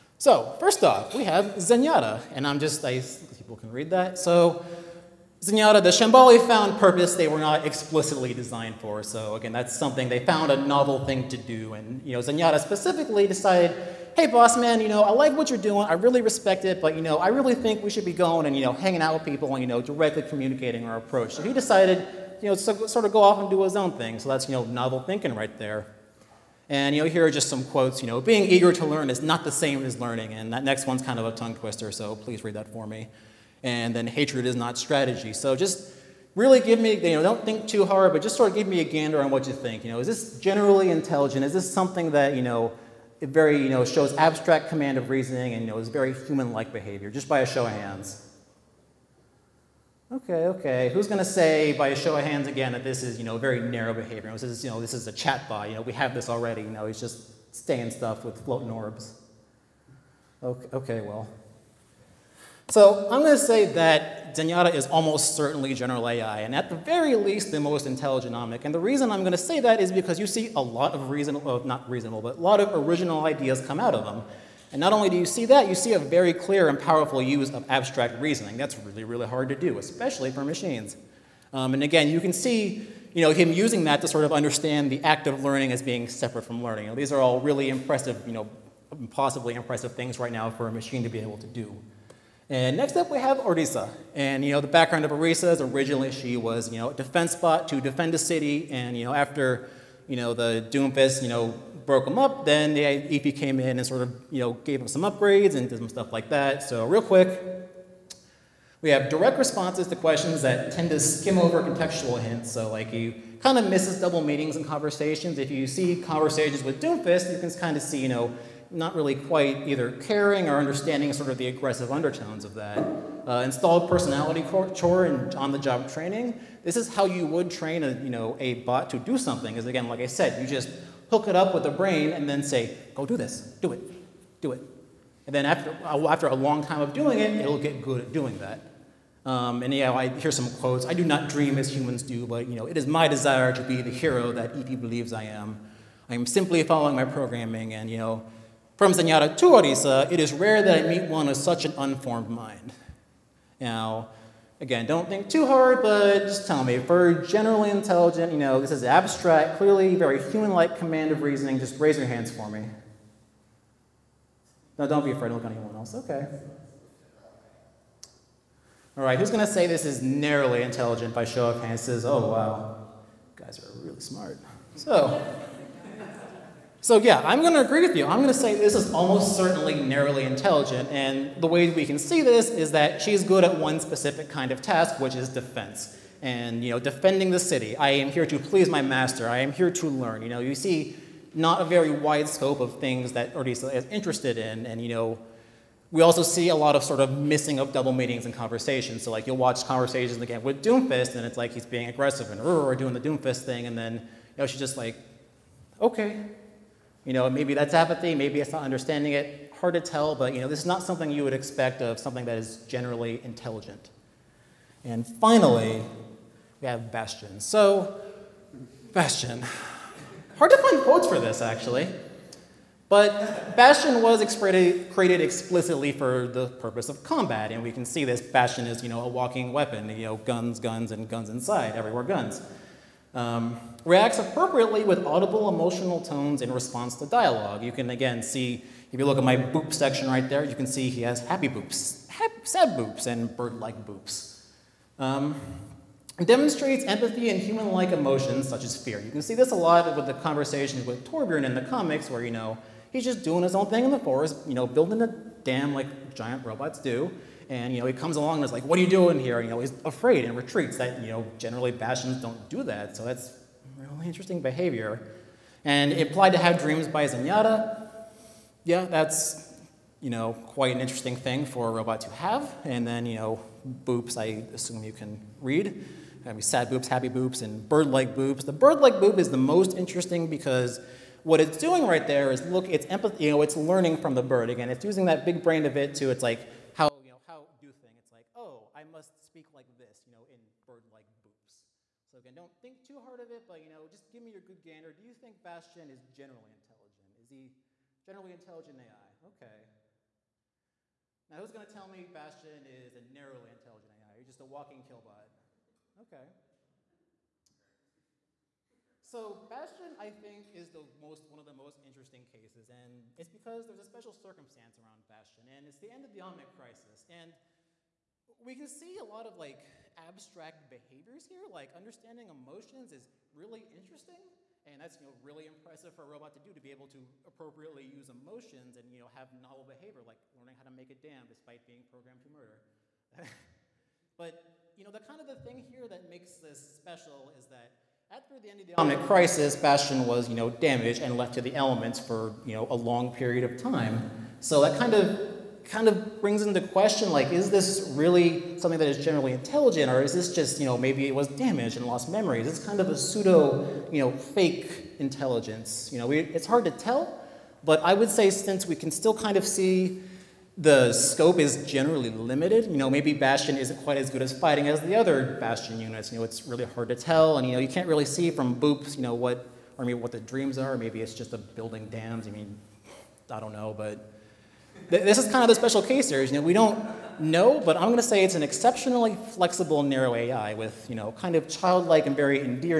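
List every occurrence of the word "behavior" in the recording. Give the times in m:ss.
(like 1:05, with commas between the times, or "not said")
0:46, 0:53, 4:24, 5:20, 5:29.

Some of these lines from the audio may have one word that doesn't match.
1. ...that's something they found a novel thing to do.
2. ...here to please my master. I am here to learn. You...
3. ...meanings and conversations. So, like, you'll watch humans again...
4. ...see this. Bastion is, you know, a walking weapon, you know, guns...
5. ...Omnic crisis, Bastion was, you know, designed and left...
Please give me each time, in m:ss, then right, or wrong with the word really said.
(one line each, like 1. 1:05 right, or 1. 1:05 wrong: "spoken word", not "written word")
1. 0:09 right
2. 3:08 right
3. 3:17 wrong: "conversations", not "humans"
4. 3:47 right
5. 5:38 wrong: "damaged", not "designed".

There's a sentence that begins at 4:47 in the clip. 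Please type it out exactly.
It's like, oh, I must speak like this, you know, in bird-like boops.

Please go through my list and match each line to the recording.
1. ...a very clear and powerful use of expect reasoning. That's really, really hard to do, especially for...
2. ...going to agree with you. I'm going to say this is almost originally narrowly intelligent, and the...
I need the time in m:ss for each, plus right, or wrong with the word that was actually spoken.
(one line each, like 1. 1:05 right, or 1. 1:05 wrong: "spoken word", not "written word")
1. 1:15 wrong: "abstract", not "expect"
2. 2:57 wrong: "certainly", not "originally".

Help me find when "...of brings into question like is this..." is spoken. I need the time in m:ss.
5:45.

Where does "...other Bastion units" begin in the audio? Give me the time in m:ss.
6:04.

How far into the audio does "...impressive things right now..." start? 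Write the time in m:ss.
1:29.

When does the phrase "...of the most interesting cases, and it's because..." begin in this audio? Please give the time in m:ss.
5:11.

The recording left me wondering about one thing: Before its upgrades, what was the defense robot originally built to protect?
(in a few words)
A city.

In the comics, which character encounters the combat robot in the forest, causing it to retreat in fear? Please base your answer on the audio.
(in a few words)
Torbjorn.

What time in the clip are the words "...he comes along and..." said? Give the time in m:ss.
4:17.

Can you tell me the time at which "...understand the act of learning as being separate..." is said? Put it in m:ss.
1:24.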